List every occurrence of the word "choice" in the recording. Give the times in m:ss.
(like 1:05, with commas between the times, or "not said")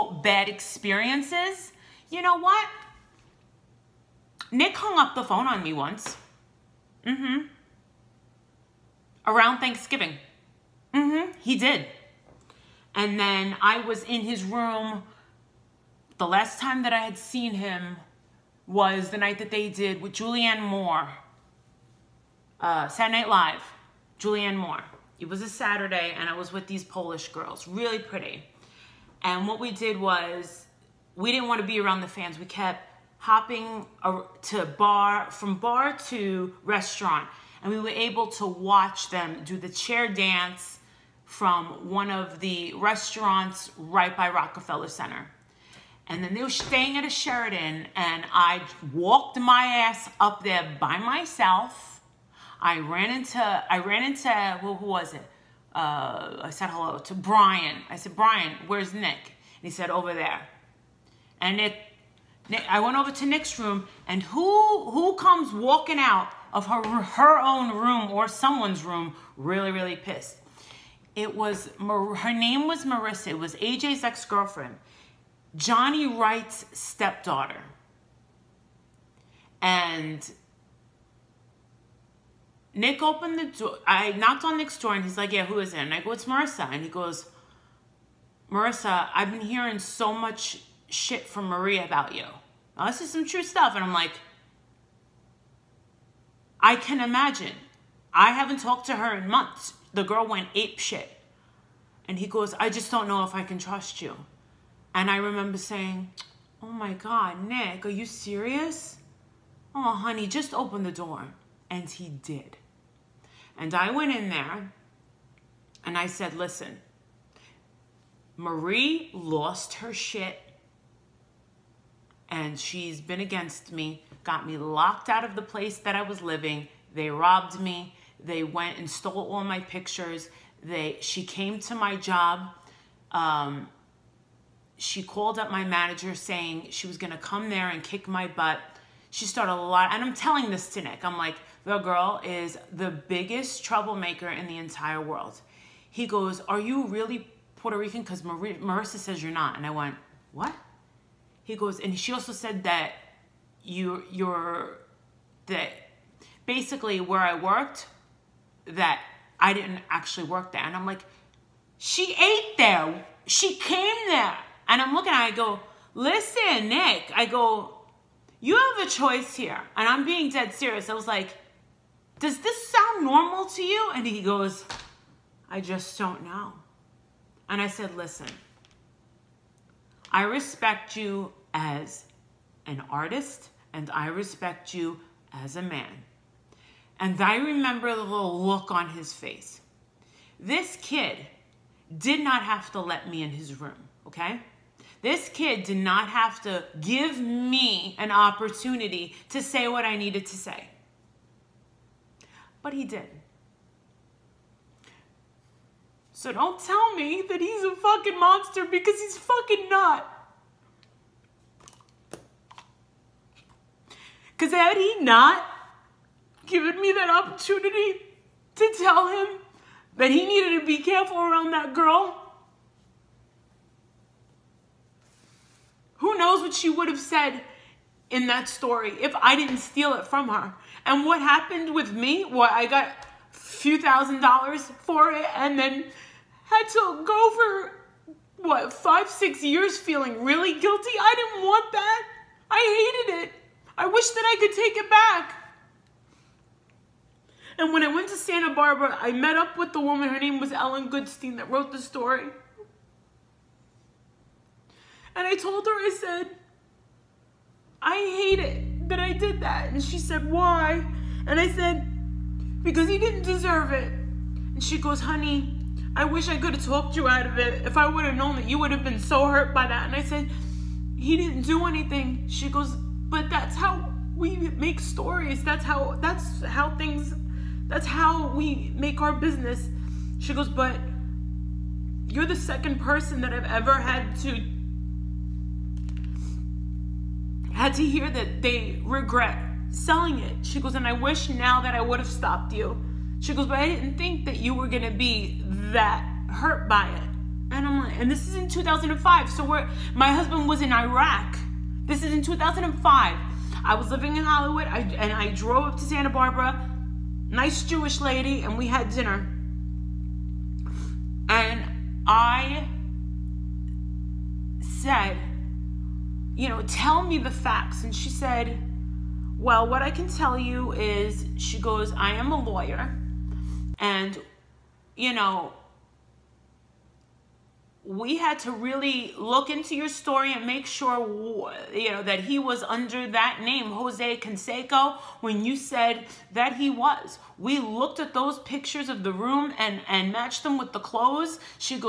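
2:48.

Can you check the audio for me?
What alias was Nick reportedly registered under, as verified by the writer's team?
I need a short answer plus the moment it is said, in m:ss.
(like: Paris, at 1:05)
Jose Canseco, at 5:33.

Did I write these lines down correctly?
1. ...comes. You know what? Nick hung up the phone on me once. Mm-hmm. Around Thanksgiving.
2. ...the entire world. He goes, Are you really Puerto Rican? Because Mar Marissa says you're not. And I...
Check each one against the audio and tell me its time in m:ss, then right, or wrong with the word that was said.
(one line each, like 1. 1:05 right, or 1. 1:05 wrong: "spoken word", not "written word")
1. 0:00 wrong: "experiences", not "comes"
2. 2:24 right.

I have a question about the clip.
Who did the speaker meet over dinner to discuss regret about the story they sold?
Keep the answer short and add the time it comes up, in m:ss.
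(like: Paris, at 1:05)
Ellen Goodstein, at 4:10.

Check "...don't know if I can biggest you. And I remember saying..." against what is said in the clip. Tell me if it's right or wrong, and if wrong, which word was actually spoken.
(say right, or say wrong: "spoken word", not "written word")
wrong: "trust", not "biggest".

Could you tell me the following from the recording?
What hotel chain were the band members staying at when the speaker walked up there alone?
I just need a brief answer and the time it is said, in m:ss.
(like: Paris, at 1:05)
Sheraton, at 0:47.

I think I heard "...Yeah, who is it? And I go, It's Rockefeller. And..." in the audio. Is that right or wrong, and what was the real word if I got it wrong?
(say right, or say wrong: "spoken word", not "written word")
wrong: "Marissa", not "Rockefeller".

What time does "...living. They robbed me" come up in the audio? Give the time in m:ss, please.
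2:06.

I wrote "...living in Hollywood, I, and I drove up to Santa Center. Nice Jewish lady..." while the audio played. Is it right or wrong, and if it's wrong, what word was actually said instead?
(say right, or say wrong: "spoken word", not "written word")
wrong: "Barbara", not "Center".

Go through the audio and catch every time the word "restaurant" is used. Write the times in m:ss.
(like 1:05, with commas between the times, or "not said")
0:36, 0:42.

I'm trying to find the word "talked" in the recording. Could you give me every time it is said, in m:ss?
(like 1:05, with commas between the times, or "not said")
1:38, 4:26.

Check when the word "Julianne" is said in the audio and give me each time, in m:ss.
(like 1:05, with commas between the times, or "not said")
0:20, 0:24.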